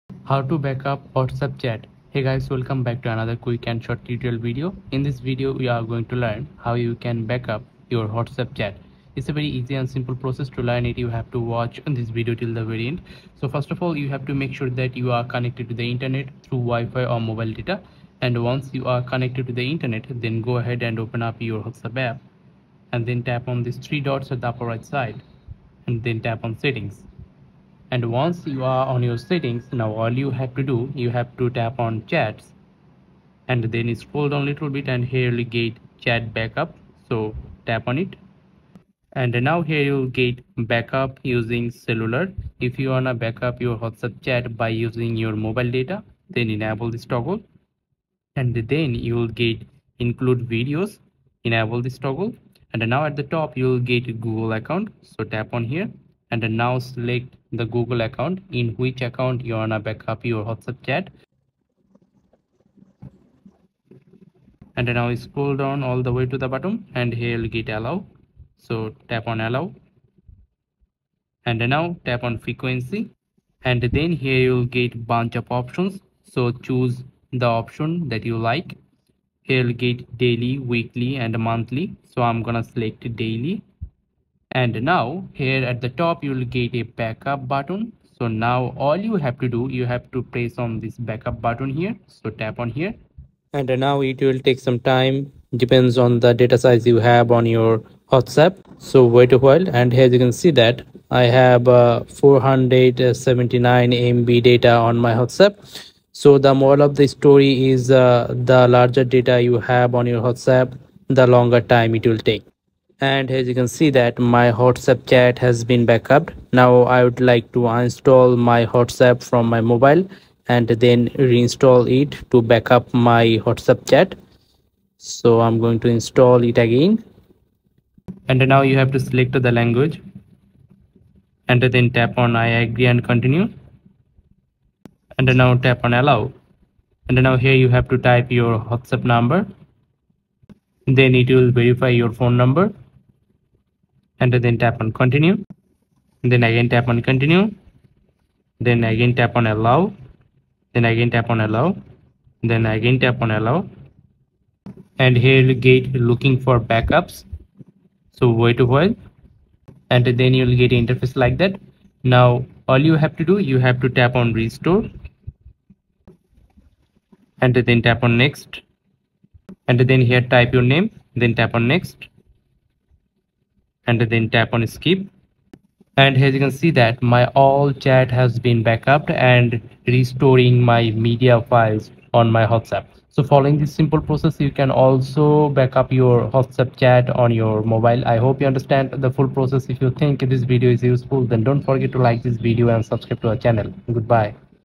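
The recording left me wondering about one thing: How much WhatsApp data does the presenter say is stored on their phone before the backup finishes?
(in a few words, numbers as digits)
479 MB.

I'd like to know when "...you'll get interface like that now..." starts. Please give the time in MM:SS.
02:40.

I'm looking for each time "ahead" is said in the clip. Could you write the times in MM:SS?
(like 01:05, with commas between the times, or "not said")
00:20.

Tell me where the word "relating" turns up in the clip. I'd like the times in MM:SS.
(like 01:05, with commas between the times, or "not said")
not said.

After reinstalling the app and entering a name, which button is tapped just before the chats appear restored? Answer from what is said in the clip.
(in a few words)
Skip.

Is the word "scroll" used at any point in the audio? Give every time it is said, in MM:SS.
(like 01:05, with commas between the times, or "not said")
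00:34, 01:05.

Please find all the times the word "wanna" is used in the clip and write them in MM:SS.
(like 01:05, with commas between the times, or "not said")
00:42, 00:59.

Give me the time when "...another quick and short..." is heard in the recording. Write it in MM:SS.
00:03.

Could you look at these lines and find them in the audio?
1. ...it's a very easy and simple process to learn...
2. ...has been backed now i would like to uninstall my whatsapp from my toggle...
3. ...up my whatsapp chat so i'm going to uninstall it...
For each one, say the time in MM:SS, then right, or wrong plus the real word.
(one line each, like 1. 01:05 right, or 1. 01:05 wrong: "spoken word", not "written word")
1. 00:09 right
2. 01:55 wrong: "mobile", not "toggle"
3. 02:02 wrong: "install", not "uninstall".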